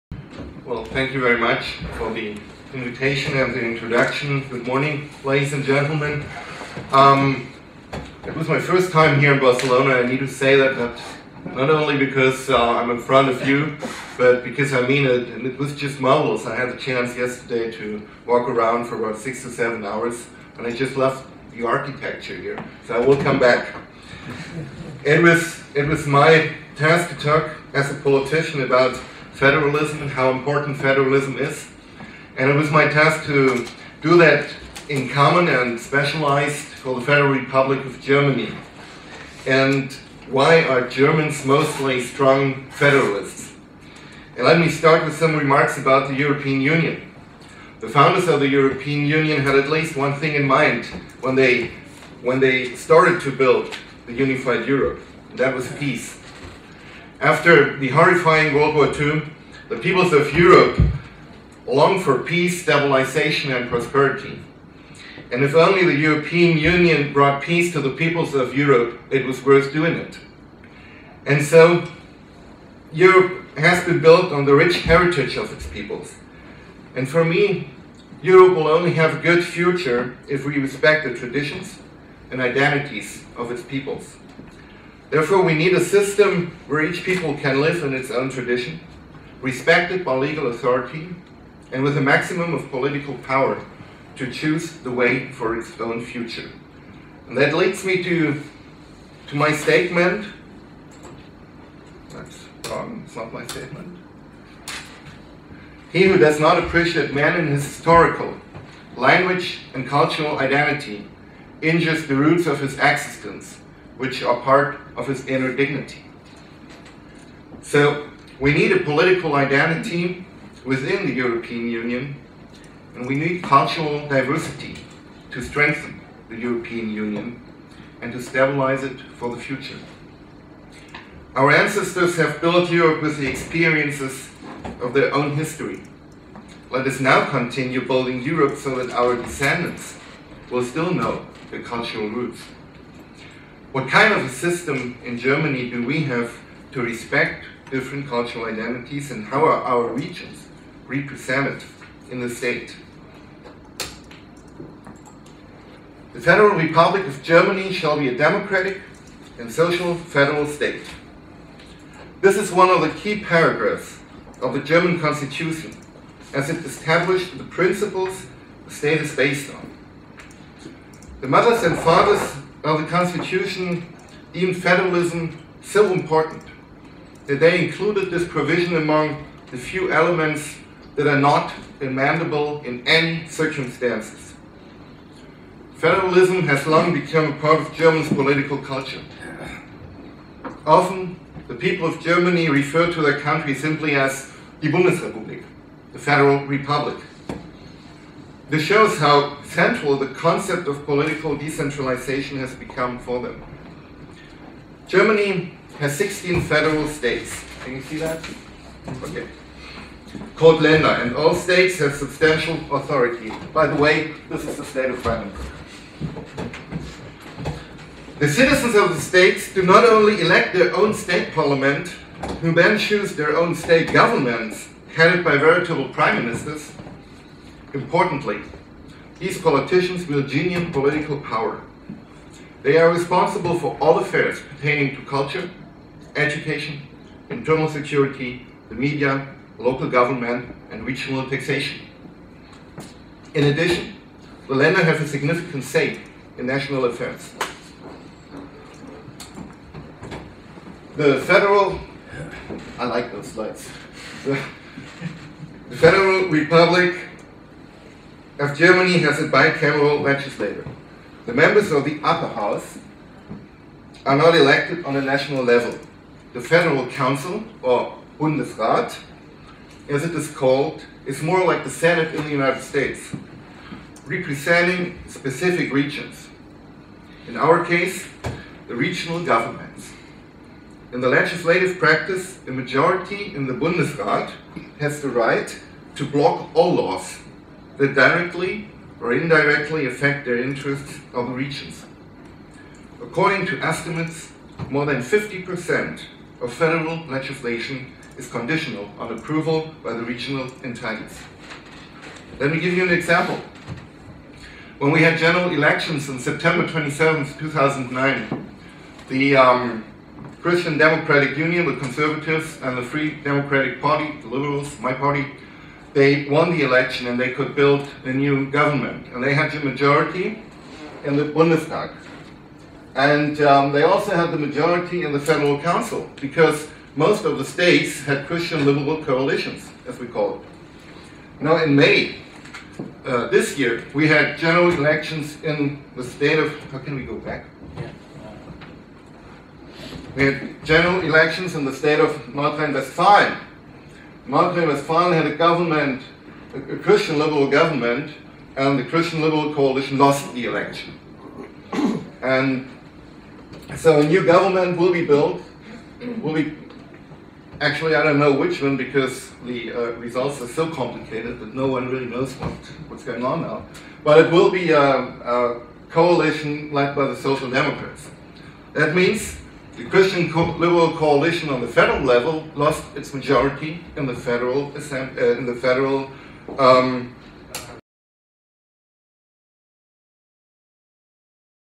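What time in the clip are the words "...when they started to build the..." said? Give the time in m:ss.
0:52.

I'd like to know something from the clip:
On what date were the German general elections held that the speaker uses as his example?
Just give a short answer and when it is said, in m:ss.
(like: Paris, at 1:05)
September 27, 2009, at 5:06.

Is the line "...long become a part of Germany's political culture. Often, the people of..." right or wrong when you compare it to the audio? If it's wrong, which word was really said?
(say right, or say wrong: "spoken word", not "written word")
right.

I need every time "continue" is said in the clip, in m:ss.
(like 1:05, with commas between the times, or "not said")
2:17.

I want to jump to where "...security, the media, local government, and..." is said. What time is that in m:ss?
3:57.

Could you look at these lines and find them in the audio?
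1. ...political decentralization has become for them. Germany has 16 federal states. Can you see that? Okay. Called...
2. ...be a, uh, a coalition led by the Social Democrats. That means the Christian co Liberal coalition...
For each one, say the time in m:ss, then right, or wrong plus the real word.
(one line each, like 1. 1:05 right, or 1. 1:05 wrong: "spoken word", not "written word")
1. 3:20 right
2. 6:04 right.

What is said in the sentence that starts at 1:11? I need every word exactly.
And so, Europe has been built on the rich heritage of its peoples.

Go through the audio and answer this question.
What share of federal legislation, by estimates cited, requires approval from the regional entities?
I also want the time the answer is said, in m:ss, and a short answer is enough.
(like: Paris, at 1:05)
More than 50%, at 4:54.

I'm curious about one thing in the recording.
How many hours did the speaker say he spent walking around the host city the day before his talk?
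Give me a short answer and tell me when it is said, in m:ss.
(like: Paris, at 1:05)
6 to 7 hours, at 0:19.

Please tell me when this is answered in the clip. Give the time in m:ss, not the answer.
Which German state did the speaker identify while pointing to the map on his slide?
3:35.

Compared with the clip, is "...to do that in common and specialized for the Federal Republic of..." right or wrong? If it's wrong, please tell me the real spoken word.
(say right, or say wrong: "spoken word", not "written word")
right.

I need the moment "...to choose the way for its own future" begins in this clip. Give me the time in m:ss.
1:34.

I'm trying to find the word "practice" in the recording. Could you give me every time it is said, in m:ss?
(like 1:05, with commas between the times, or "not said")
4:41.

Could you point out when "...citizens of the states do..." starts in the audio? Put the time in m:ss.
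3:38.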